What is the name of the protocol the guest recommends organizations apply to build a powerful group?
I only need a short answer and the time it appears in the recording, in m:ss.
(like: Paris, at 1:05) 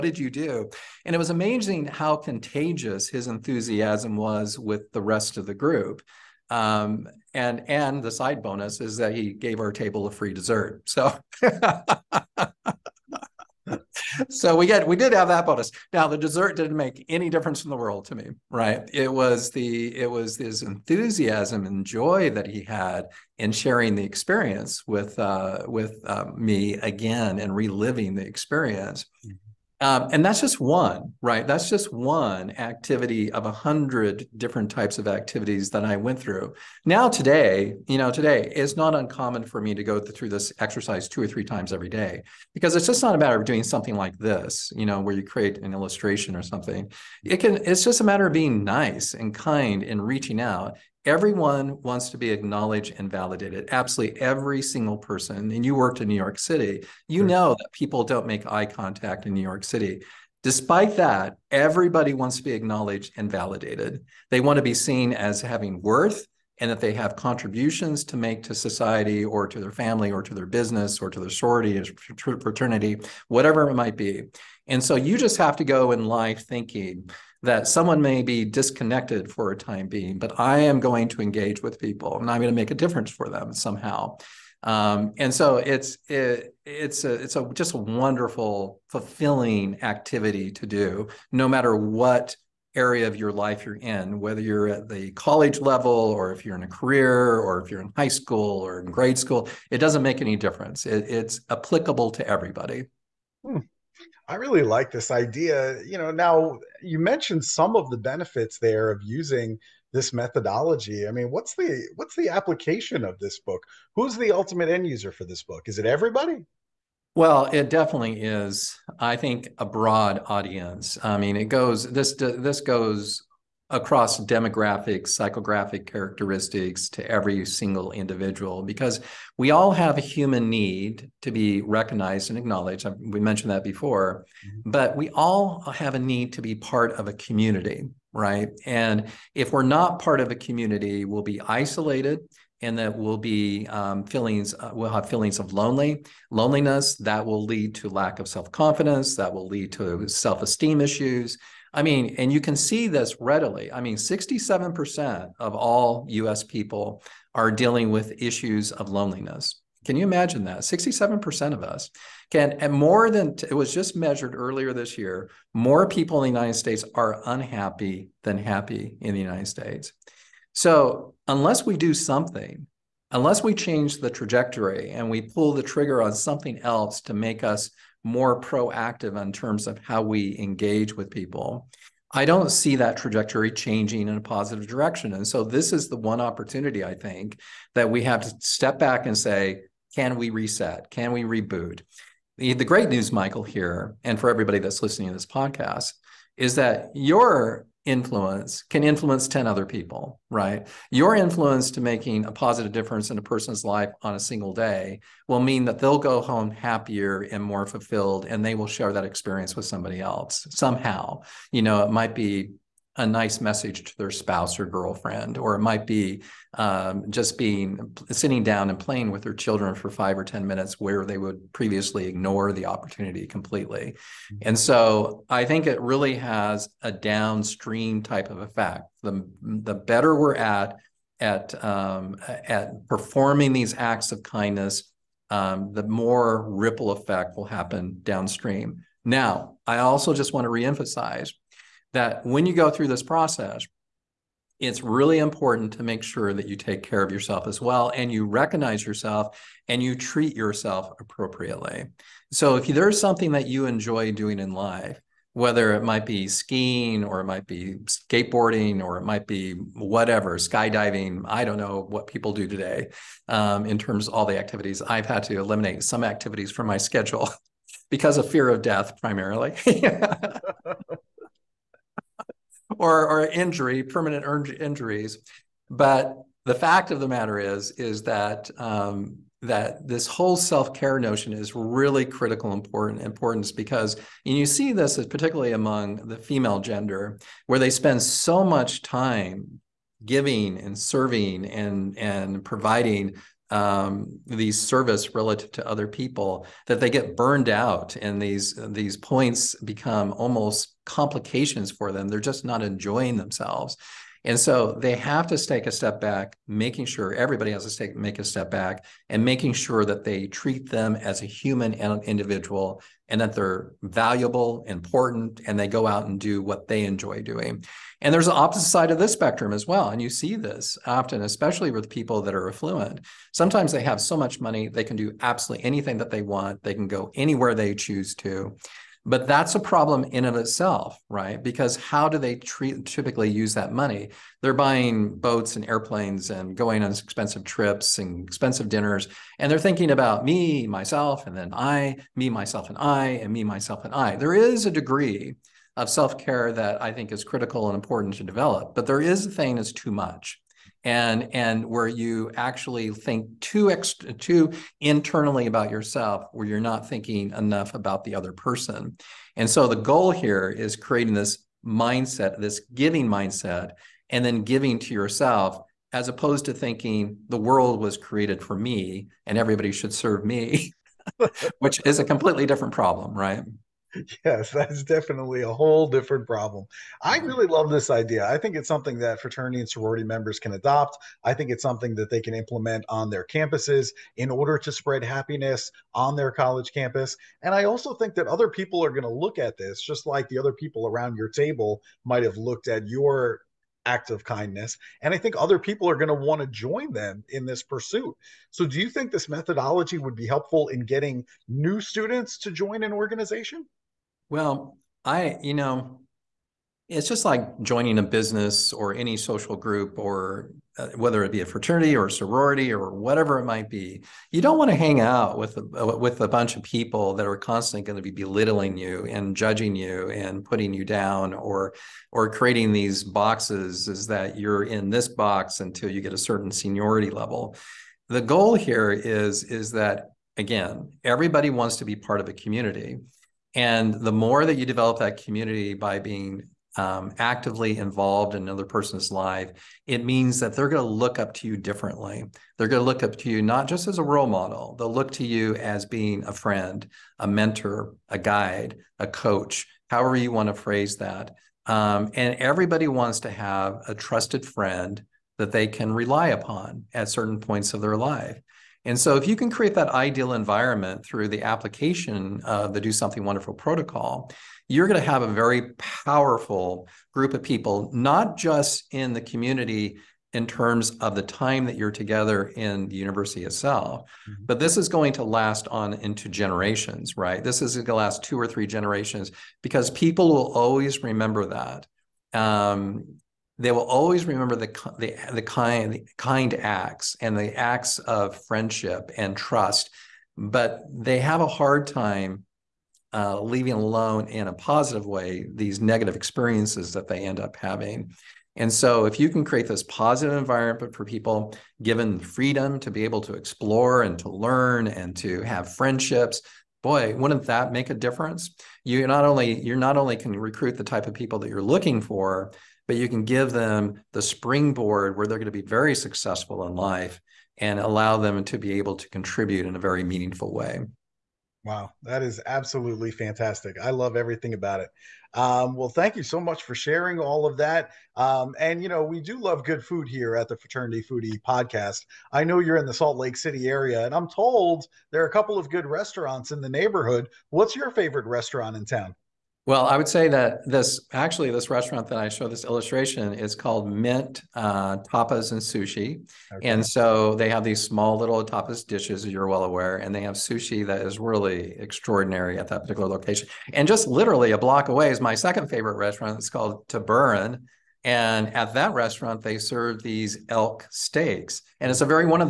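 Do Something Wonderful, at 7:42.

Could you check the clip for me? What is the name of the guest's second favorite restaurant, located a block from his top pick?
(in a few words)
Taburin.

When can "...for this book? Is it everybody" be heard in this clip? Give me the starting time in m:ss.
1:55.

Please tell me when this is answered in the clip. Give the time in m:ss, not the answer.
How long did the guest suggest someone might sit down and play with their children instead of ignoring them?
3:39.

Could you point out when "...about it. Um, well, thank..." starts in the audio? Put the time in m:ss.
8:44.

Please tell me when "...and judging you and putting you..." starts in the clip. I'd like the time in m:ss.
6:59.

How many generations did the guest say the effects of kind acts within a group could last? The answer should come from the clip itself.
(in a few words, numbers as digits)
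2 or 3.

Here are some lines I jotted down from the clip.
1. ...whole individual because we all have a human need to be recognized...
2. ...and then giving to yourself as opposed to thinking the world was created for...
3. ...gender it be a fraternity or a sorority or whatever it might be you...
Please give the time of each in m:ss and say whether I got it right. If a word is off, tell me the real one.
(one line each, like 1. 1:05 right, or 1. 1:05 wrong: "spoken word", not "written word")
1. 2:07 wrong: "single", not "whole"
2. 6:04 right
3. 6:50 wrong: "whether", not "gender".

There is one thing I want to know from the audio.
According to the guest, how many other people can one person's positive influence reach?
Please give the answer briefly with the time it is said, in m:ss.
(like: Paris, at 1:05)
10, at 3:19.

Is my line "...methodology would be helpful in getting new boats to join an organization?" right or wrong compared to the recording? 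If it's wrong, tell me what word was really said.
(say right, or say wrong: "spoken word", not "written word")
wrong: "students", not "boats".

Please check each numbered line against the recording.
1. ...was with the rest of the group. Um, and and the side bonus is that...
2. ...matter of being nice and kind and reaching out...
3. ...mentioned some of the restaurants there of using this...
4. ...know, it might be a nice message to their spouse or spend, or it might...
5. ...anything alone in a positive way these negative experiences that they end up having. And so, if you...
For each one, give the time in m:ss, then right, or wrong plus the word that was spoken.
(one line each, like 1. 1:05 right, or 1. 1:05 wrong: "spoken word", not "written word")
1. 0:04 right
2. 0:48 right
3. 1:46 wrong: "benefits", not "restaurants"
4. 3:31 wrong: "girlfriend", not "spend"
5. 8:13 wrong: "leaving", not "anything".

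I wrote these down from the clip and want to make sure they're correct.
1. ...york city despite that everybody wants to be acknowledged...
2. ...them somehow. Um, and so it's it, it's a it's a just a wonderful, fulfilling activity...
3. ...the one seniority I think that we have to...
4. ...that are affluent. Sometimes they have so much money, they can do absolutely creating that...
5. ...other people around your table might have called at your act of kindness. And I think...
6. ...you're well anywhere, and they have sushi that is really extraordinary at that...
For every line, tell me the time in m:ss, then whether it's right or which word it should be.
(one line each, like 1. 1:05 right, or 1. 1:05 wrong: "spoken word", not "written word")
1. 0:59 right
2. 1:23 right
3. 3:05 wrong: "opportunity", not "seniority"
4. 5:22 wrong: "anything", not "creating"
5. 6:30 wrong: "looked", not "called"
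6. 9:09 wrong: "aware", not "anywhere".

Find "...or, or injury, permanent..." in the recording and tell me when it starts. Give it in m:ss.
4:32.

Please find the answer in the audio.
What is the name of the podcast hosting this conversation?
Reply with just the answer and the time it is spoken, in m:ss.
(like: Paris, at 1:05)
Fraternity Foodie, at 8:50.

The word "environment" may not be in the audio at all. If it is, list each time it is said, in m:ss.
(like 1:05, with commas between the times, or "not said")
7:40, 8:20.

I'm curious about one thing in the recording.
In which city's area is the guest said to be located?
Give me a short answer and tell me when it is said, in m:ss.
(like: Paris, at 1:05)
Salt Lake City, at 8:52.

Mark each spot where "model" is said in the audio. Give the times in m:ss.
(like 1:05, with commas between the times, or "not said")
7:24.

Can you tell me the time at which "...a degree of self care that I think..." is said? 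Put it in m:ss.
5:44.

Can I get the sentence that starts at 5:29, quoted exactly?
But that's a problem in of itself, right?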